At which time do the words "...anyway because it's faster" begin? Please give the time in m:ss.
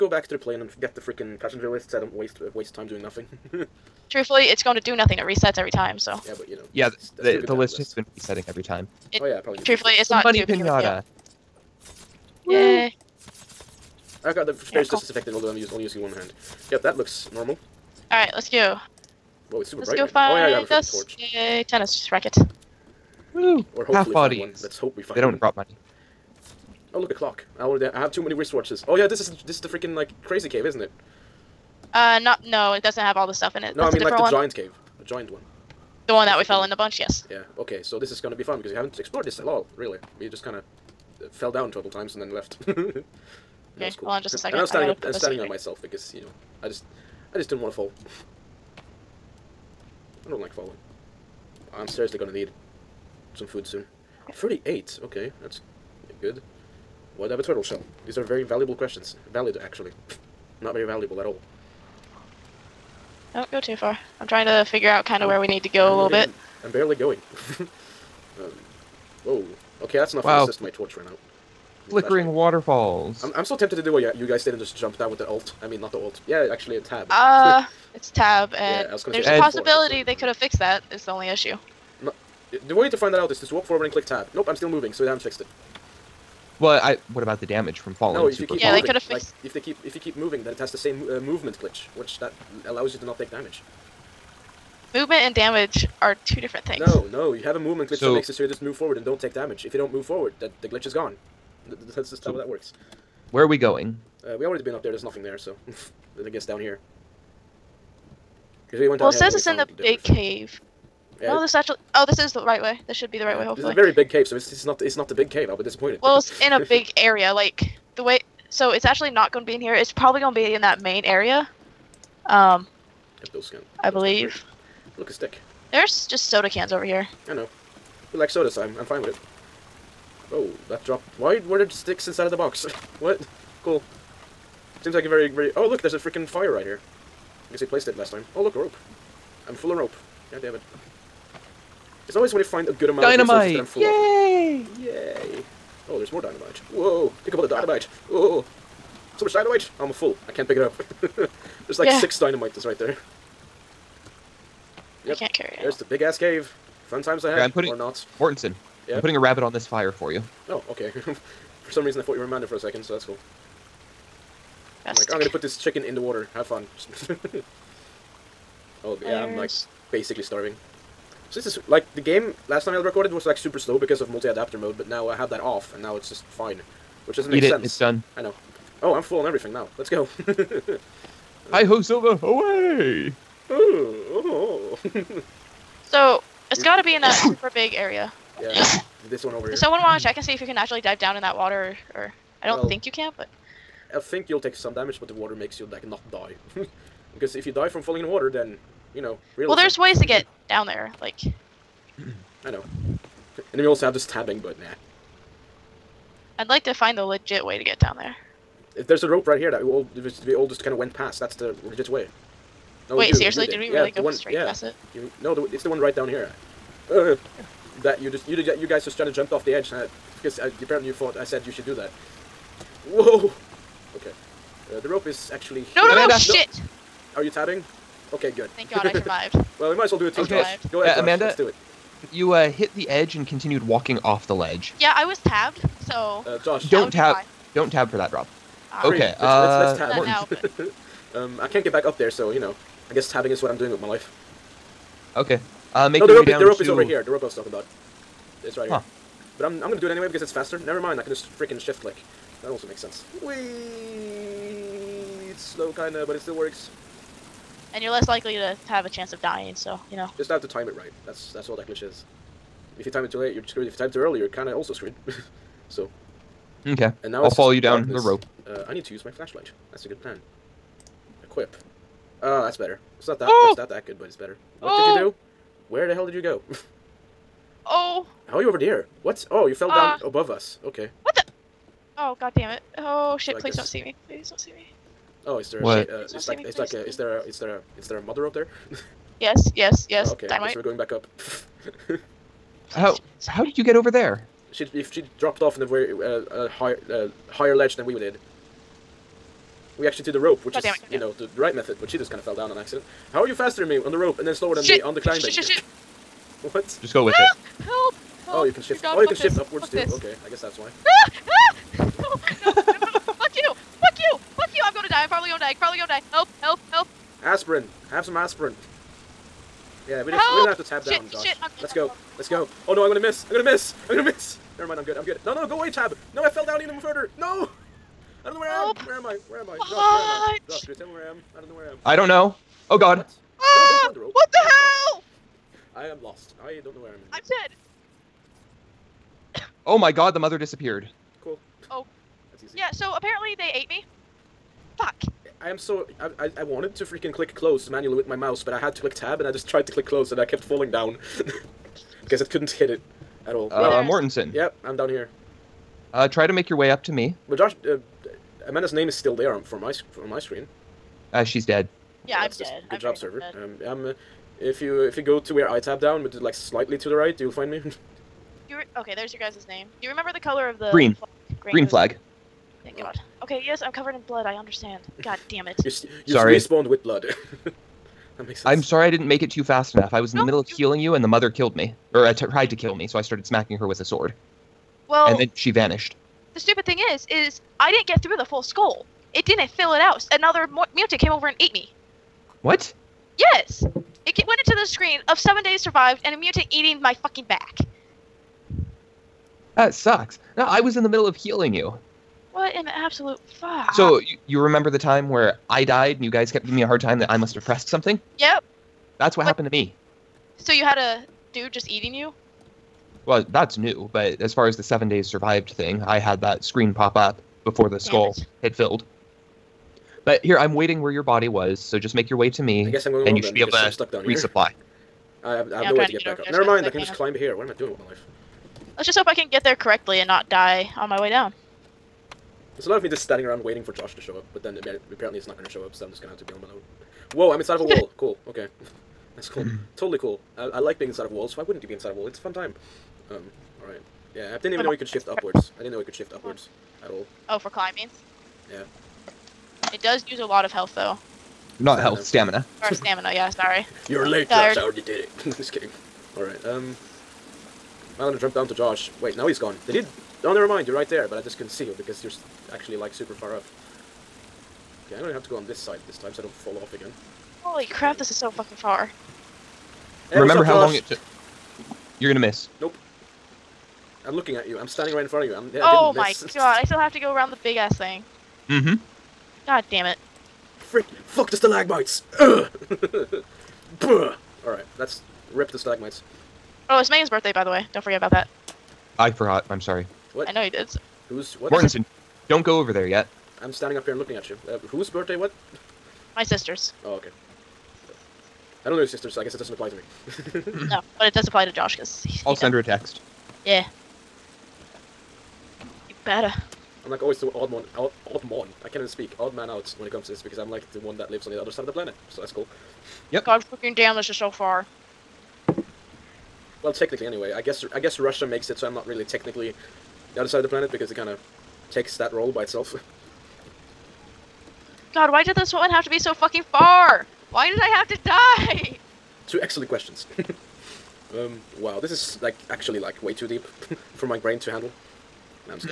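4:09.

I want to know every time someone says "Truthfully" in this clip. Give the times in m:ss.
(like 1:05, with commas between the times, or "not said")
0:04, 0:09.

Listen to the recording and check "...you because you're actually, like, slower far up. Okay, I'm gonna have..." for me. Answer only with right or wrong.
wrong.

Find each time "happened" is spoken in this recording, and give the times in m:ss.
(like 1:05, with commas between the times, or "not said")
6:49.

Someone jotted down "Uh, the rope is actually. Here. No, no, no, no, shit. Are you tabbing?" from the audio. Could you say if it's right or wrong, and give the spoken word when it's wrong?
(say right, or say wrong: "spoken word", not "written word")
right.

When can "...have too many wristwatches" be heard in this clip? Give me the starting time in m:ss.
0:27.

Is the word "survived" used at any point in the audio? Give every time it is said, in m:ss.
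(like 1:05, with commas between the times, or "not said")
3:48, 6:35, 6:55.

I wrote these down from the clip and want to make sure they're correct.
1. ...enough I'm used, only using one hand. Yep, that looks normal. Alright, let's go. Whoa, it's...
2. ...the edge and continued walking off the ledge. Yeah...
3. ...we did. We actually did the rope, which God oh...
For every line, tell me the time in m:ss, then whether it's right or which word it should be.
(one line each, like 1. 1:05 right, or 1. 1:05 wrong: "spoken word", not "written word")
1. 0:15 wrong: "although", not "enough"
2. 3:52 right
3. 4:57 right.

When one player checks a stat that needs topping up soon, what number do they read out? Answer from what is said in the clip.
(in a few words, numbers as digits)
38.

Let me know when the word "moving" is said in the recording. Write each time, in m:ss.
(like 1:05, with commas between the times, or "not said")
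1:24, 1:30.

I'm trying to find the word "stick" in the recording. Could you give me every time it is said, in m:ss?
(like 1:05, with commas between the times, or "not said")
2:05, 2:11.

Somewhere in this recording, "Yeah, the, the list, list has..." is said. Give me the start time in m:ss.
0:06.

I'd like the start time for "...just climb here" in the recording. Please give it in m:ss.
7:06.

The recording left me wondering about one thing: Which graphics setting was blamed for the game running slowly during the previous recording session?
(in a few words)
Multi-adapter mode.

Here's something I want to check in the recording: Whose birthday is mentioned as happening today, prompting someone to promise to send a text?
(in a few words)
Megan.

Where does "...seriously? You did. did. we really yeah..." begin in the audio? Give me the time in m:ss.
3:33.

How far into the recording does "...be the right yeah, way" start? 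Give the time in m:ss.
1:53.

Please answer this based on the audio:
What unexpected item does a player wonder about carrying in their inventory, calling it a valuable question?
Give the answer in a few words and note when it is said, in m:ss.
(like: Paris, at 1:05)
A turtle shell, at 0:57.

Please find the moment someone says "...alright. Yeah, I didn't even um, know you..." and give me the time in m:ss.
7:23.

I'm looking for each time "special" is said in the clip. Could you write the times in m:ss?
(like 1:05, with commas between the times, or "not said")
not said.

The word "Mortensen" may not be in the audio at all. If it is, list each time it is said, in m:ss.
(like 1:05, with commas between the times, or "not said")
2:38, 5:53, 8:11.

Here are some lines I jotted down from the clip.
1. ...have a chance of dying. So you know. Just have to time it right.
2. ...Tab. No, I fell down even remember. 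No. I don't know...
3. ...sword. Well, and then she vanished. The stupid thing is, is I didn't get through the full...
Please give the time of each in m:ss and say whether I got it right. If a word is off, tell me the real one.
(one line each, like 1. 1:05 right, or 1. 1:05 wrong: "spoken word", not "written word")
1. 4:18 right
2. 5:25 wrong: "further", not "remember"
3. 6:23 right.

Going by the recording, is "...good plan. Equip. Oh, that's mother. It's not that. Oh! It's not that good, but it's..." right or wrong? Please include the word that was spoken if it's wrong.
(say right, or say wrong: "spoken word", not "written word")
wrong: "better", not "mother".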